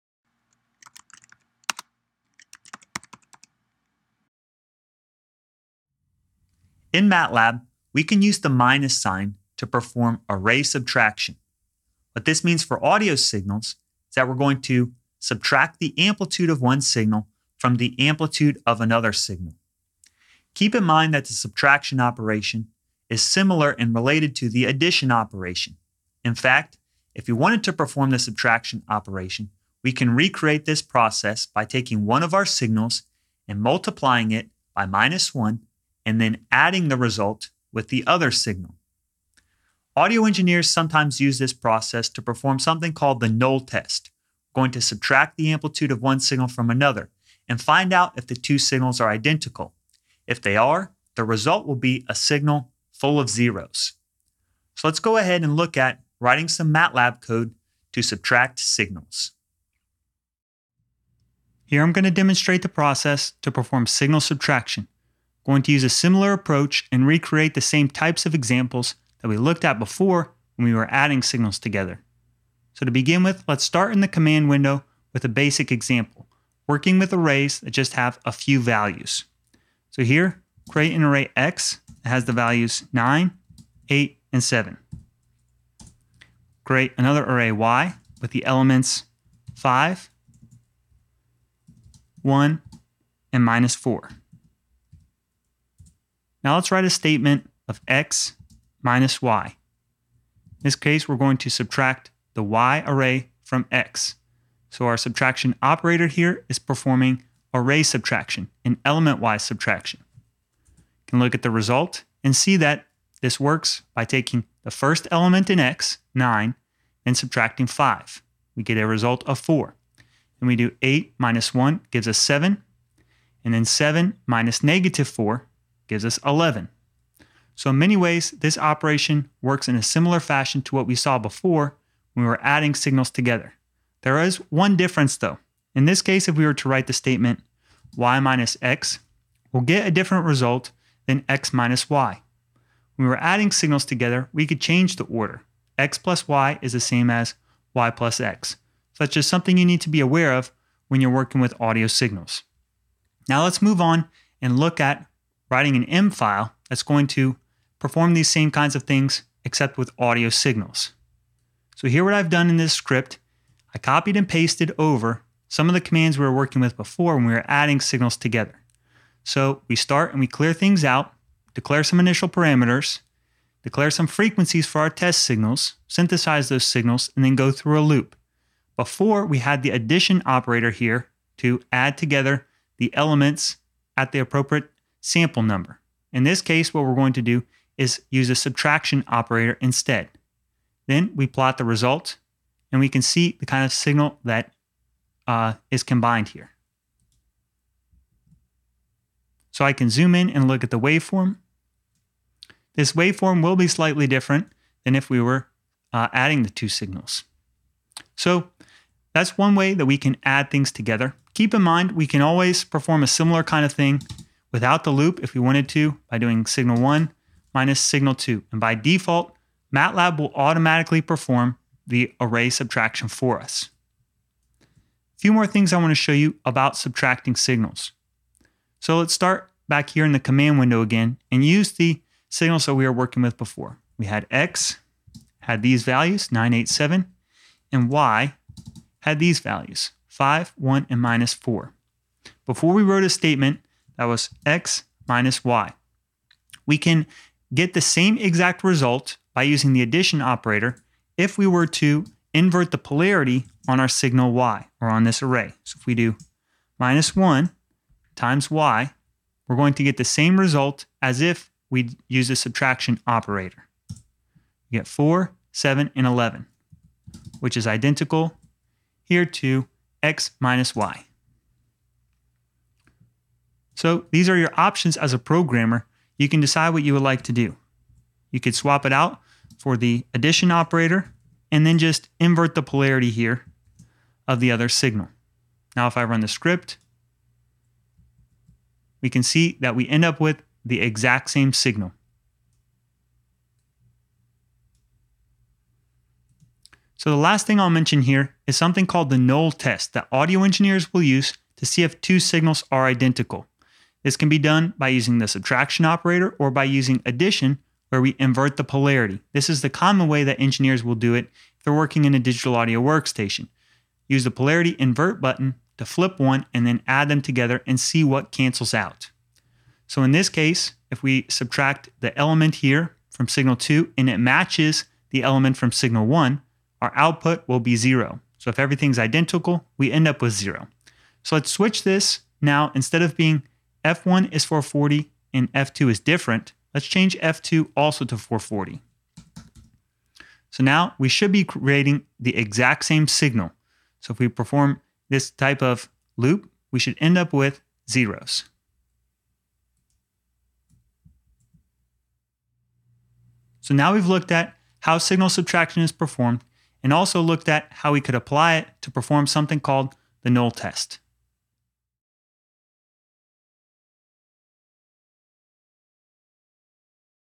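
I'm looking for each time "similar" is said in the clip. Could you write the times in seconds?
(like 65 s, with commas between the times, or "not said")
23 s, 65 s, 129 s, 213 s.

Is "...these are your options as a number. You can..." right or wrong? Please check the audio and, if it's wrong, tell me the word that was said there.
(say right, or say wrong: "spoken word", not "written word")
wrong: "programmer", not "number".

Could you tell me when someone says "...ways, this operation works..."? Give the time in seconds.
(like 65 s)
127 s.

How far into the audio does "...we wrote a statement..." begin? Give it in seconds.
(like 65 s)
242 s.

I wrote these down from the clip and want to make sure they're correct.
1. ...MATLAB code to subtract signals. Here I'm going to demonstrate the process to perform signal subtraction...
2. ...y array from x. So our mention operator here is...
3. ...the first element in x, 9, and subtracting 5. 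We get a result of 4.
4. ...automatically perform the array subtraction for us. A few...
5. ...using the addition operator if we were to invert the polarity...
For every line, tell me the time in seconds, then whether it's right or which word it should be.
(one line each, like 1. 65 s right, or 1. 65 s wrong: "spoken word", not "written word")
1. 56 s right
2. 102 s wrong: "subtraction", not "mention"
3. 114 s right
4. 220 s right
5. 249 s right.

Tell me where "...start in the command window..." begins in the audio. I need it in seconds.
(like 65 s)
73 s.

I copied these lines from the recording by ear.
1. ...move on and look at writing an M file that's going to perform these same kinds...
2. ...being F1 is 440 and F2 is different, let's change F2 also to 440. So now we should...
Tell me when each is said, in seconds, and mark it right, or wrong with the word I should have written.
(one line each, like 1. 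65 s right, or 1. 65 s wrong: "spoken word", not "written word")
1. 153 s right
2. 333 s right.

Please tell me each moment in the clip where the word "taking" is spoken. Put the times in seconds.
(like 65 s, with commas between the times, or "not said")
31 s, 114 s.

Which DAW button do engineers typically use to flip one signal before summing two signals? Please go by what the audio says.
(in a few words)
polarity invert button.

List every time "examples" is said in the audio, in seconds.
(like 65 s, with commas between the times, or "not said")
68 s, 75 s.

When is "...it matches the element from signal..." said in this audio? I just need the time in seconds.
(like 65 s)
324 s.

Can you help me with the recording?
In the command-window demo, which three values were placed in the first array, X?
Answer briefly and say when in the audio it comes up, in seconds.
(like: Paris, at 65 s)
9, 8, and 7, at 82 s.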